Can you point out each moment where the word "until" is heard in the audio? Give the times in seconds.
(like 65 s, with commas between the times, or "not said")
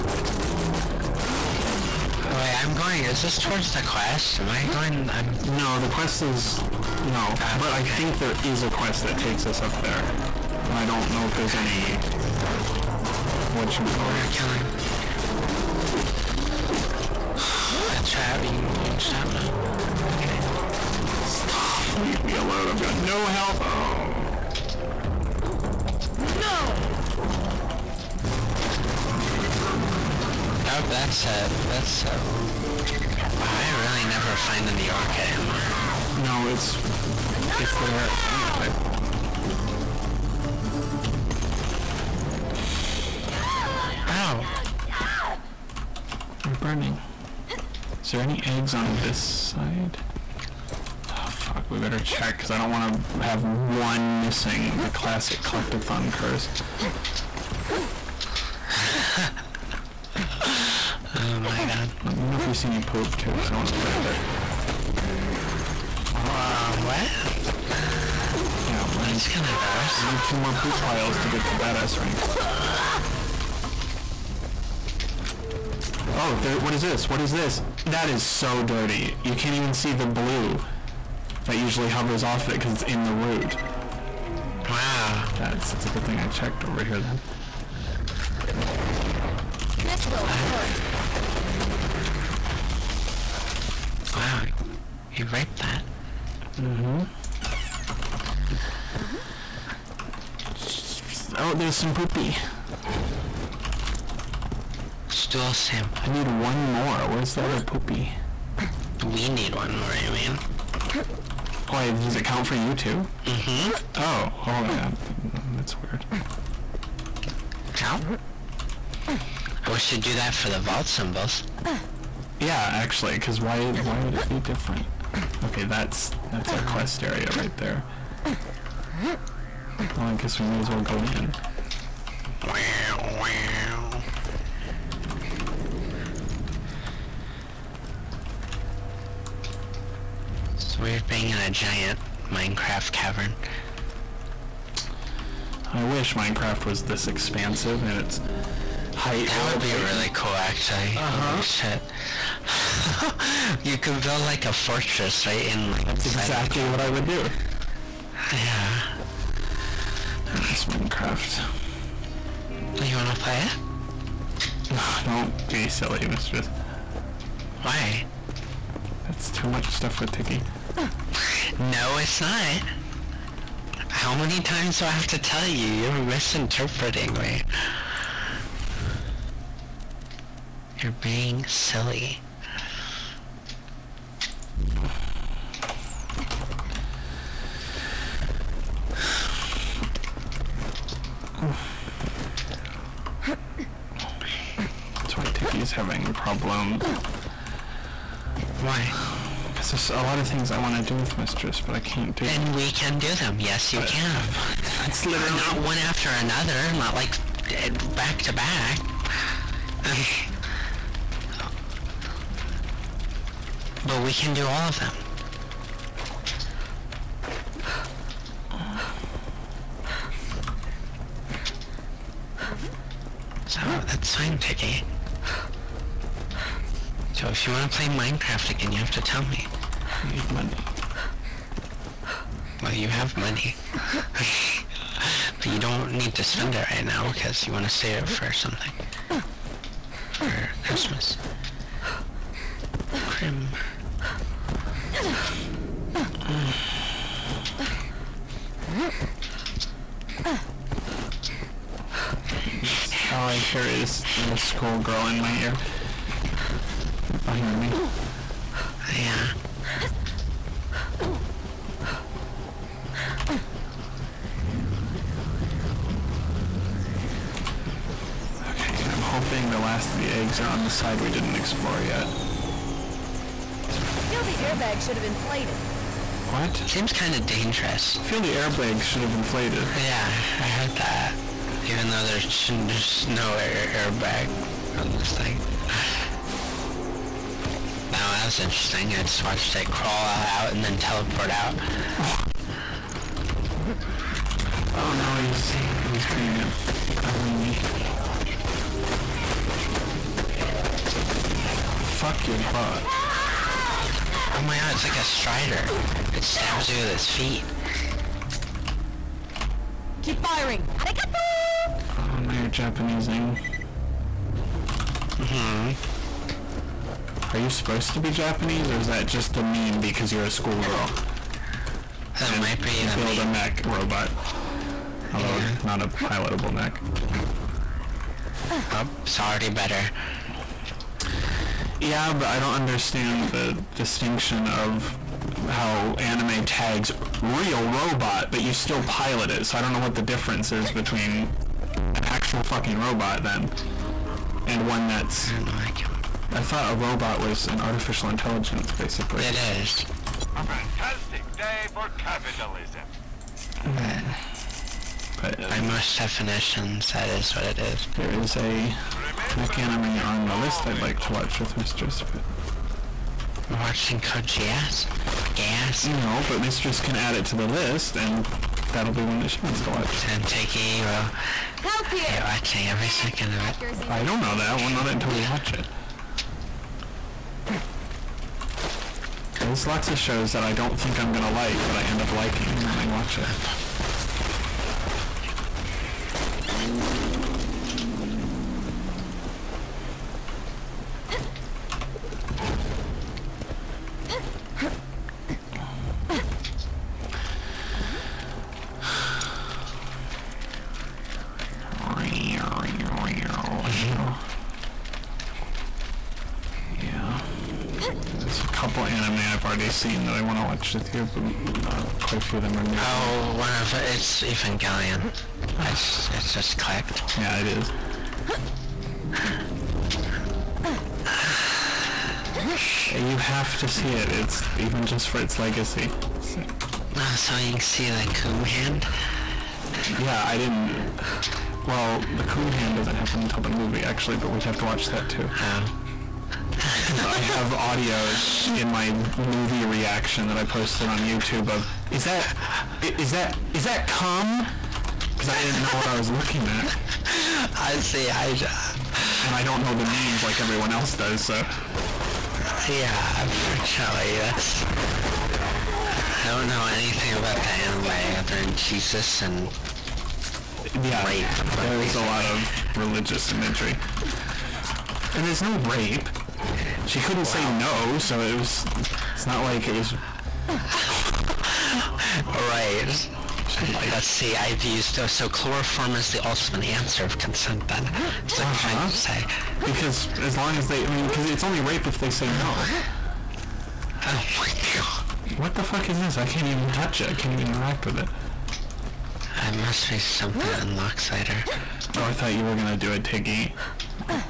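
374 s, 433 s.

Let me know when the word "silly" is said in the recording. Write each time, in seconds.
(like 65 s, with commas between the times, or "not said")
165 s, 181 s.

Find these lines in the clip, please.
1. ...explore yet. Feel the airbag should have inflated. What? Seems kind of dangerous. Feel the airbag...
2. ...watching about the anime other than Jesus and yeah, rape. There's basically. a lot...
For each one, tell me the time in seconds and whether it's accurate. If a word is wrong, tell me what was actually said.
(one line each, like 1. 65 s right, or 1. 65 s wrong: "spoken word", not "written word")
1. 271 s right
2. 456 s wrong: "anything", not "watching".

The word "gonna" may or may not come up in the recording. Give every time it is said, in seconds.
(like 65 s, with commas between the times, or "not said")
381 s, 492 s.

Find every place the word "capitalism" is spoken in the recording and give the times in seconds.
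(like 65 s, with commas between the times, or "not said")
351 s.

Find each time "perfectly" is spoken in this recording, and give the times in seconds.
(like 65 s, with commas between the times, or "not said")
not said.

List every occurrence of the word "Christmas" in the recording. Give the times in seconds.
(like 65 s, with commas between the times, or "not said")
240 s.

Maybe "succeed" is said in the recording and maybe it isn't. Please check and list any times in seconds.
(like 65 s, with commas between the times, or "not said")
not said.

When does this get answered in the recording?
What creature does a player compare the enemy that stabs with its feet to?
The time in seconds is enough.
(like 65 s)
304 s.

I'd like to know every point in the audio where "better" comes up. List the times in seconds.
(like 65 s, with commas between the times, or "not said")
51 s, 329 s.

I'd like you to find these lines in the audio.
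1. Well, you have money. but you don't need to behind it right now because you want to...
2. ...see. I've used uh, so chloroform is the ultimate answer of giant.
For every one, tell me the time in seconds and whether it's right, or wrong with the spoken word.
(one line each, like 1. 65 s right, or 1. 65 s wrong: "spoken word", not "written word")
1. 232 s wrong: "spend", not "behind"
2. 474 s wrong: "consent", not "giant".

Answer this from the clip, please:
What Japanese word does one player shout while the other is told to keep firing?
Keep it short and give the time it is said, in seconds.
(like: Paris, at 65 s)
Arigato, at 310 s.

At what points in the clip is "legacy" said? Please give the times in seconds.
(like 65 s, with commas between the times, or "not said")
425 s.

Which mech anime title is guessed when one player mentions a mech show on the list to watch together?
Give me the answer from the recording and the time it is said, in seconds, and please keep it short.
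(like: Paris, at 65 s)
Code Geass, at 363 s.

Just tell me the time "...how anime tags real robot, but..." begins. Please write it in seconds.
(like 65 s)
335 s.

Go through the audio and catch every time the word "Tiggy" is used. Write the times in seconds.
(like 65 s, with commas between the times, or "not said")
224 s, 493 s.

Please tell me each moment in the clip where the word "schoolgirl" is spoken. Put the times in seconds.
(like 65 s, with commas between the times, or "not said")
254 s, 320 s.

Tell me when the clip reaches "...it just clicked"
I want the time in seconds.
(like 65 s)
416 s.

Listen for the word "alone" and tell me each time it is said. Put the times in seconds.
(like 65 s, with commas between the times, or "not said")
22 s.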